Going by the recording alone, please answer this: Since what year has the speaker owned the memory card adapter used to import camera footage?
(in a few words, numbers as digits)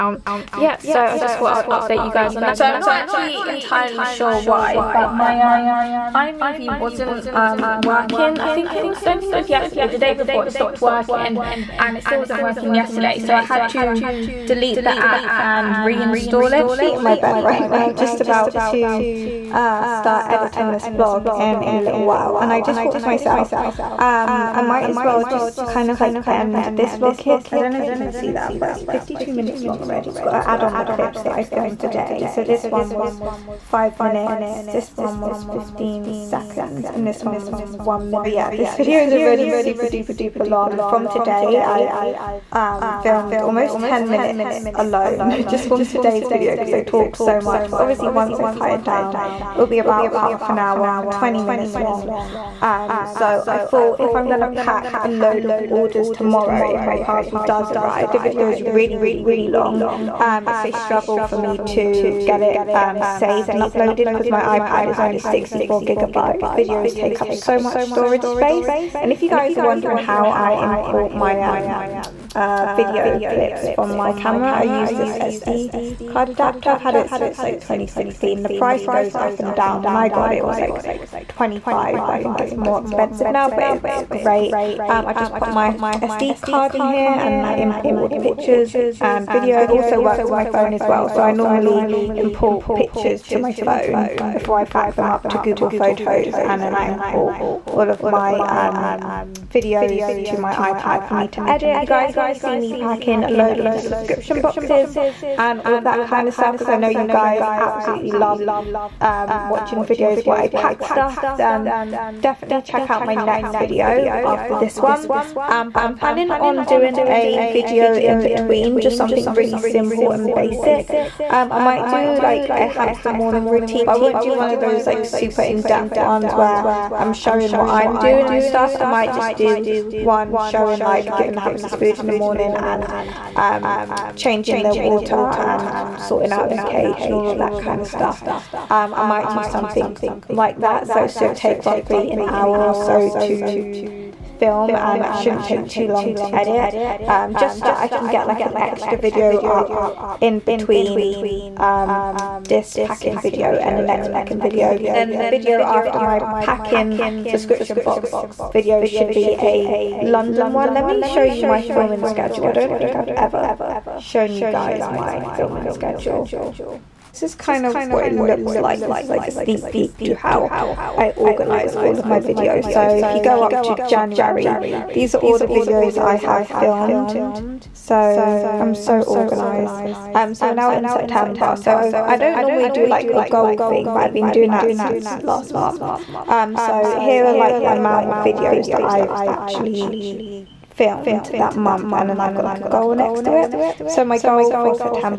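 2016.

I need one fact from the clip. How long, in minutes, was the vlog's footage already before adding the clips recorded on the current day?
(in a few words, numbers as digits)
52 minutes.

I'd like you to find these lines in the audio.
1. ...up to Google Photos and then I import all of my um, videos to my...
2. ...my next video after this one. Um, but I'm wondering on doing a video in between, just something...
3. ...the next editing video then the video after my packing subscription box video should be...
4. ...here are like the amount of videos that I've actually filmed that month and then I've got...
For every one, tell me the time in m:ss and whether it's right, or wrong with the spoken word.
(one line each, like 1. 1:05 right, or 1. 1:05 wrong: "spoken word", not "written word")
1. 1:35 right
2. 1:53 wrong: "planning", not "wondering"
3. 2:33 wrong: "packing", not "editing"
4. 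3:06 right.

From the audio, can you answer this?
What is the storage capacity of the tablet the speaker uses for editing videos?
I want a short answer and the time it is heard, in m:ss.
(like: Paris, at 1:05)
64 gigabytes, at 1:05.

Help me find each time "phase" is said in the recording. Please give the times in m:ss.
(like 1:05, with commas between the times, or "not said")
not said.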